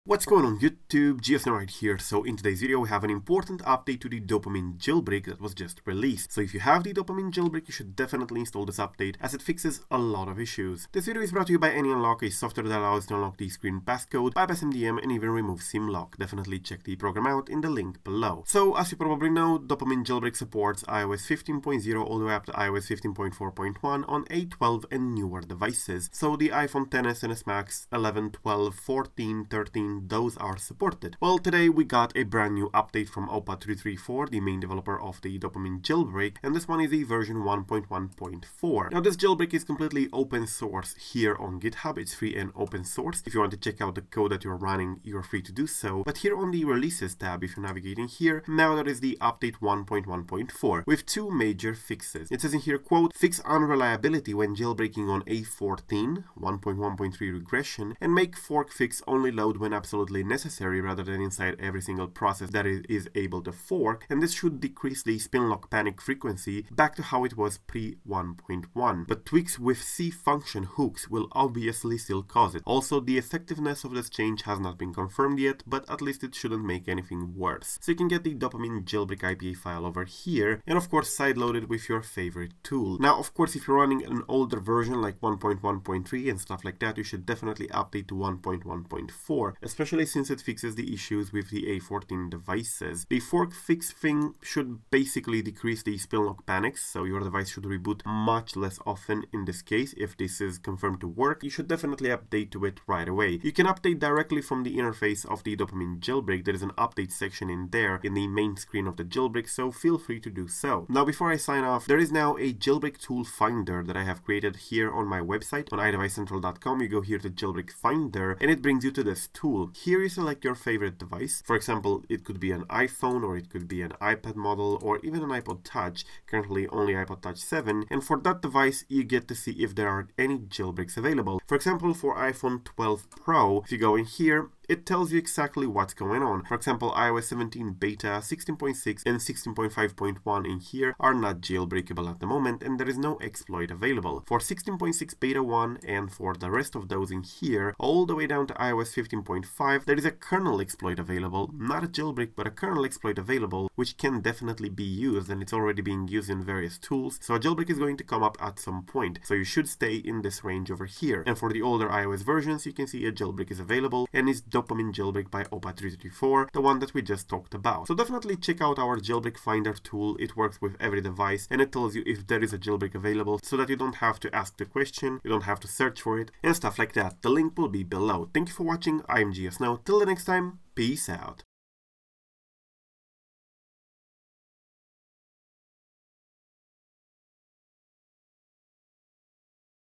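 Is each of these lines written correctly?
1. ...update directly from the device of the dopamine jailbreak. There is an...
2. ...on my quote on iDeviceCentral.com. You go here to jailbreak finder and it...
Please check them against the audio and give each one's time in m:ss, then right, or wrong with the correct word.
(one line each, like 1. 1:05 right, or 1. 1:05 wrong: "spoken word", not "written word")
1. 1:43 wrong: "interface", not "device"
2. 1:54 wrong: "website", not "quote".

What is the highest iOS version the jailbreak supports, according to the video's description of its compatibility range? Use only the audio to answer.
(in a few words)
iOS 15.4.1.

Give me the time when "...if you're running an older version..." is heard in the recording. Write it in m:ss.
1:23.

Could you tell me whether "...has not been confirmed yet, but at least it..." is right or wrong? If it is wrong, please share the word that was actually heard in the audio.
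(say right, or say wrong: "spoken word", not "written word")
right.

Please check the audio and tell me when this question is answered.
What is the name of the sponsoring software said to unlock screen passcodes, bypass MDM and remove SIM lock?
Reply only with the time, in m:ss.
0:11.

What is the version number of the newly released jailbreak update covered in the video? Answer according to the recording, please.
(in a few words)
1.1.4.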